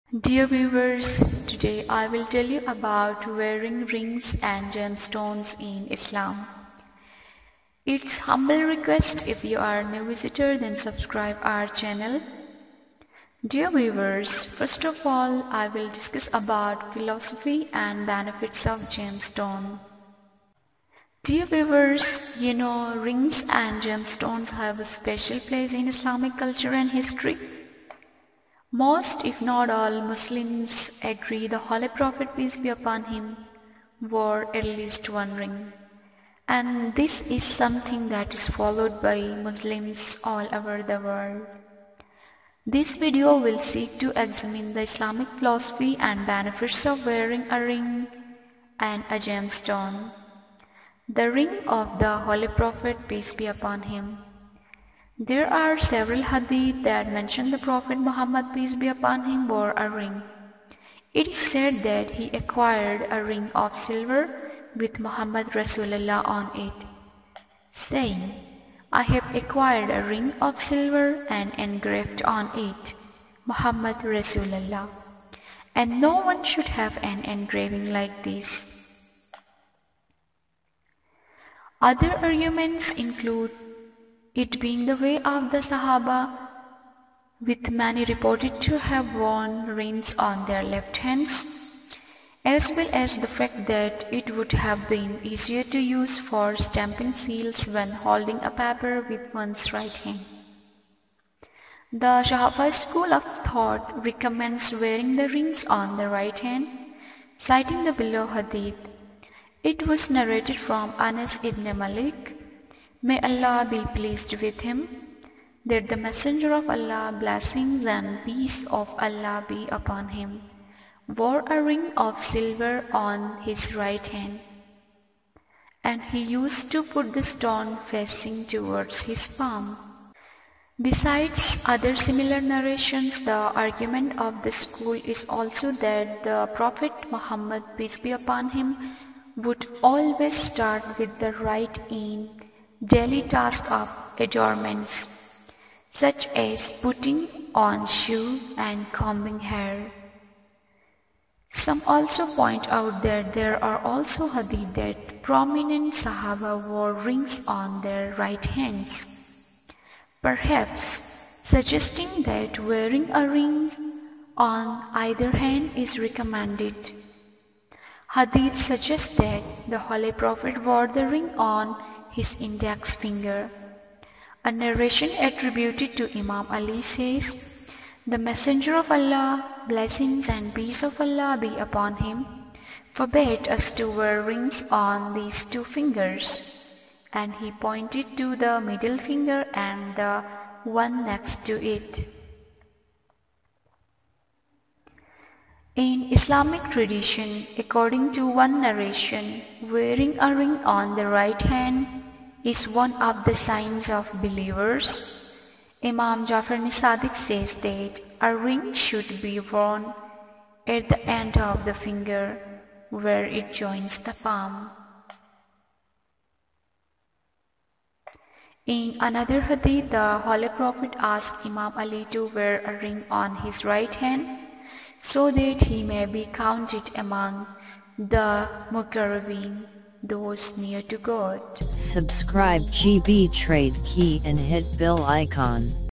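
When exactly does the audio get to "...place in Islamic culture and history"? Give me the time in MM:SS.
00:25.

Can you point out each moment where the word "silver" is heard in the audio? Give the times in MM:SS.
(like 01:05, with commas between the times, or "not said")
01:03, 01:10, 02:02.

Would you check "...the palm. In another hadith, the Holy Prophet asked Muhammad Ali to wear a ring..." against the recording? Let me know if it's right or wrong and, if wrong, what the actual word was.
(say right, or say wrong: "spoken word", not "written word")
wrong: "Imam", not "Muhammad".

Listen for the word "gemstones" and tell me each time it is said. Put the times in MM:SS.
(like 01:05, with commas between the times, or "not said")
00:04, 00:18, 00:23, 00:49.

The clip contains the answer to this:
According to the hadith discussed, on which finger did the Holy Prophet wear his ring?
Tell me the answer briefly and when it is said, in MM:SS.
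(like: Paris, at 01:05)
index finger, at 02:52.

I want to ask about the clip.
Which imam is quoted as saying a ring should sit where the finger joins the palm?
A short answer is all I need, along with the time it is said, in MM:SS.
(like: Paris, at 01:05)
Imam Jafar as-Sadiq, at 03:25.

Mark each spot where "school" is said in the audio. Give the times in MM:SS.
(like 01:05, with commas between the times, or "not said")
01:42, 02:14.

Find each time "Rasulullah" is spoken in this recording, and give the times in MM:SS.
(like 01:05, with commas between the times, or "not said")
01:05, 01:14.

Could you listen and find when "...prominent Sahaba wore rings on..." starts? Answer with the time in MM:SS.
02:35.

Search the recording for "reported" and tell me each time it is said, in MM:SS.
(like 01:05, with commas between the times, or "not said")
01:28.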